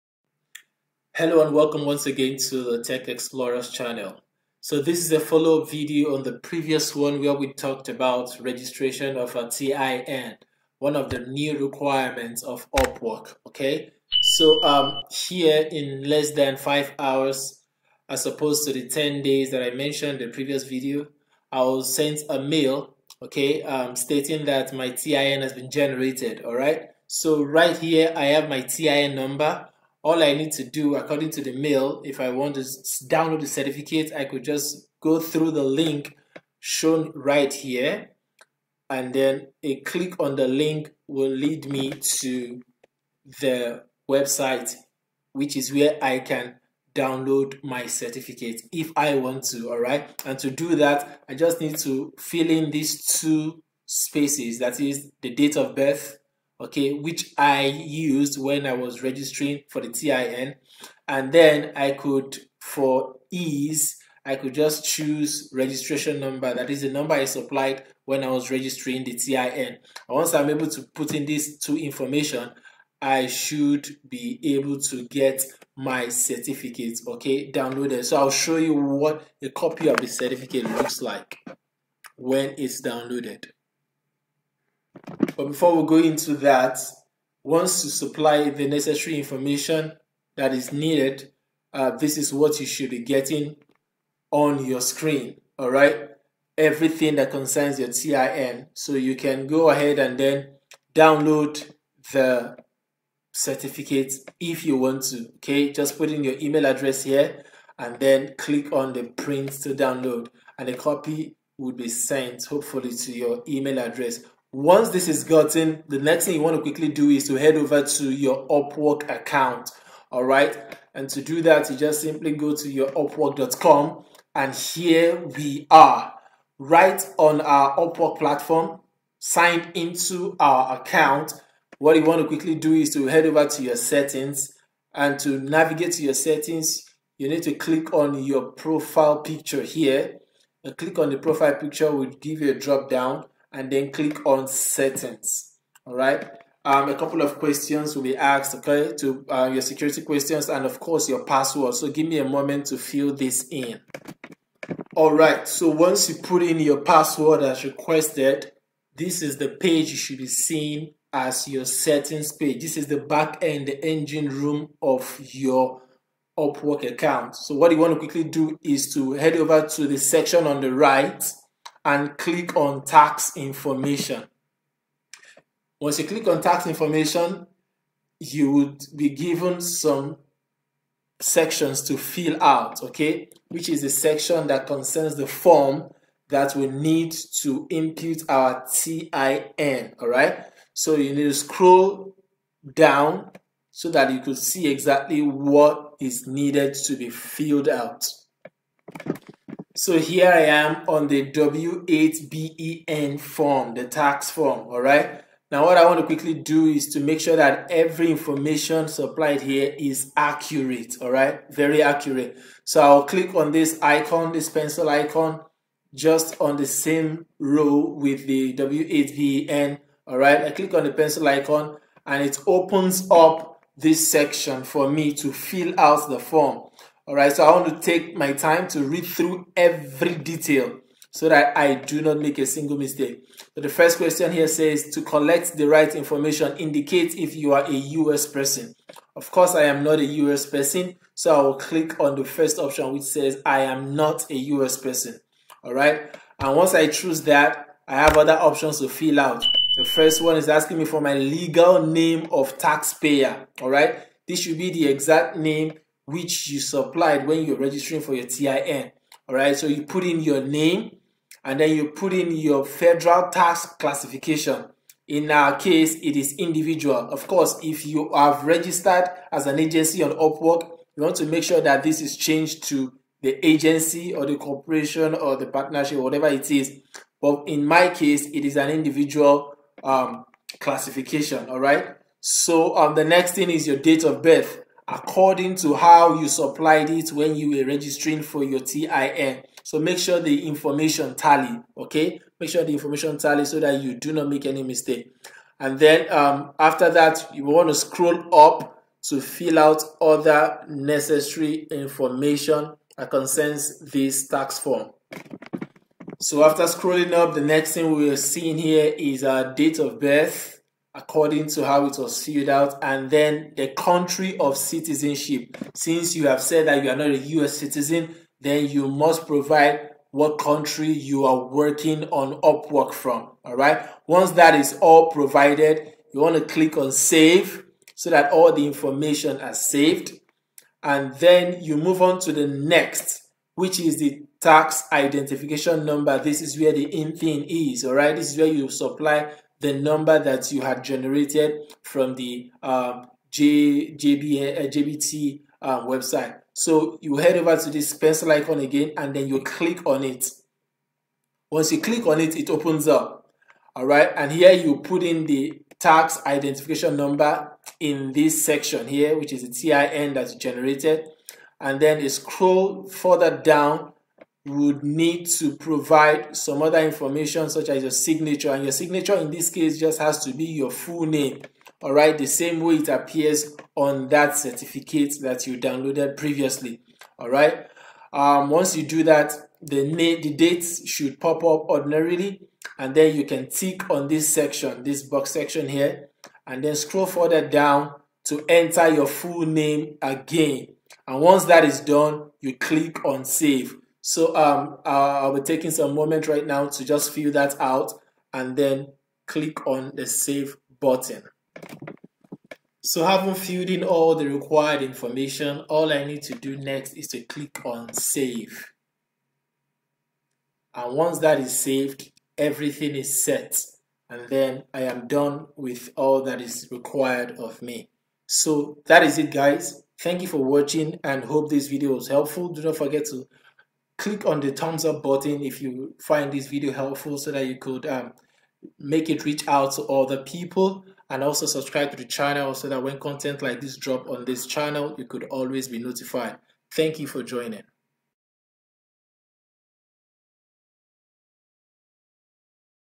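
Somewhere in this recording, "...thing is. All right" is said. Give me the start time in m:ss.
5:37.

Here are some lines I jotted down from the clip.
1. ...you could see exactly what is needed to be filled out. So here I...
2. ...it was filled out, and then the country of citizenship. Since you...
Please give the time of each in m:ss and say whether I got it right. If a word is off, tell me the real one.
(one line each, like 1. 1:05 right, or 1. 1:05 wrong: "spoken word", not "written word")
1. 3:14 right
2. 5:11 right.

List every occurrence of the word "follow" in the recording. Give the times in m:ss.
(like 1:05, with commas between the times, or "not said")
0:05.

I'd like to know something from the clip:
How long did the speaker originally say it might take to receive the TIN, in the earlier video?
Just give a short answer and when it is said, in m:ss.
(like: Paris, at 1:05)
10 days, at 0:18.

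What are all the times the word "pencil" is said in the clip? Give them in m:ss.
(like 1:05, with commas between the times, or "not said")
3:34, 3:40, 5:47.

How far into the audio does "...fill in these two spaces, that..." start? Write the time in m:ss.
0:52.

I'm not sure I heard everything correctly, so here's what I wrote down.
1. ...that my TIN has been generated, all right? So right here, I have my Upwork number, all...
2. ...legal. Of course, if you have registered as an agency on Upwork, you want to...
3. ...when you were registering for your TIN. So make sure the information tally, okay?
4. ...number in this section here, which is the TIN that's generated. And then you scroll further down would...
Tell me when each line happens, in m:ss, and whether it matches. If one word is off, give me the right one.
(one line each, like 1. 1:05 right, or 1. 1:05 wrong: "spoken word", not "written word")
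1. 0:24 wrong: "TIN", not "Upwork"
2. 4:26 wrong: "individual", not "legal"
3. 4:47 right
4. 5:56 right.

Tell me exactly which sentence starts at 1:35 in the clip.
All right, everything that concerns your TIN.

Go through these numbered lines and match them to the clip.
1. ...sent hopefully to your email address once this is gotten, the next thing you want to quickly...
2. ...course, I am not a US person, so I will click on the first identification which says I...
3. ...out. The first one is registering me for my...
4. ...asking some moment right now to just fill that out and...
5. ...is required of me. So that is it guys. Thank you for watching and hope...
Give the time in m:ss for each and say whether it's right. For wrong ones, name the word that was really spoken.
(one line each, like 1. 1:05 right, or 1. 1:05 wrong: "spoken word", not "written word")
1. 1:51 right
2. 3:59 wrong: "option", not "identification"
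3. 4:09 wrong: "asking", not "registering"
4. 6:35 wrong: "taking", not "asking"
5. 6:56 right.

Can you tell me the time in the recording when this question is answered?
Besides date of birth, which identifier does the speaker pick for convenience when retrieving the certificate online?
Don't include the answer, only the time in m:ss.
1:05.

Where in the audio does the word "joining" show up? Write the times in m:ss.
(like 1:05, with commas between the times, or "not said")
7:17.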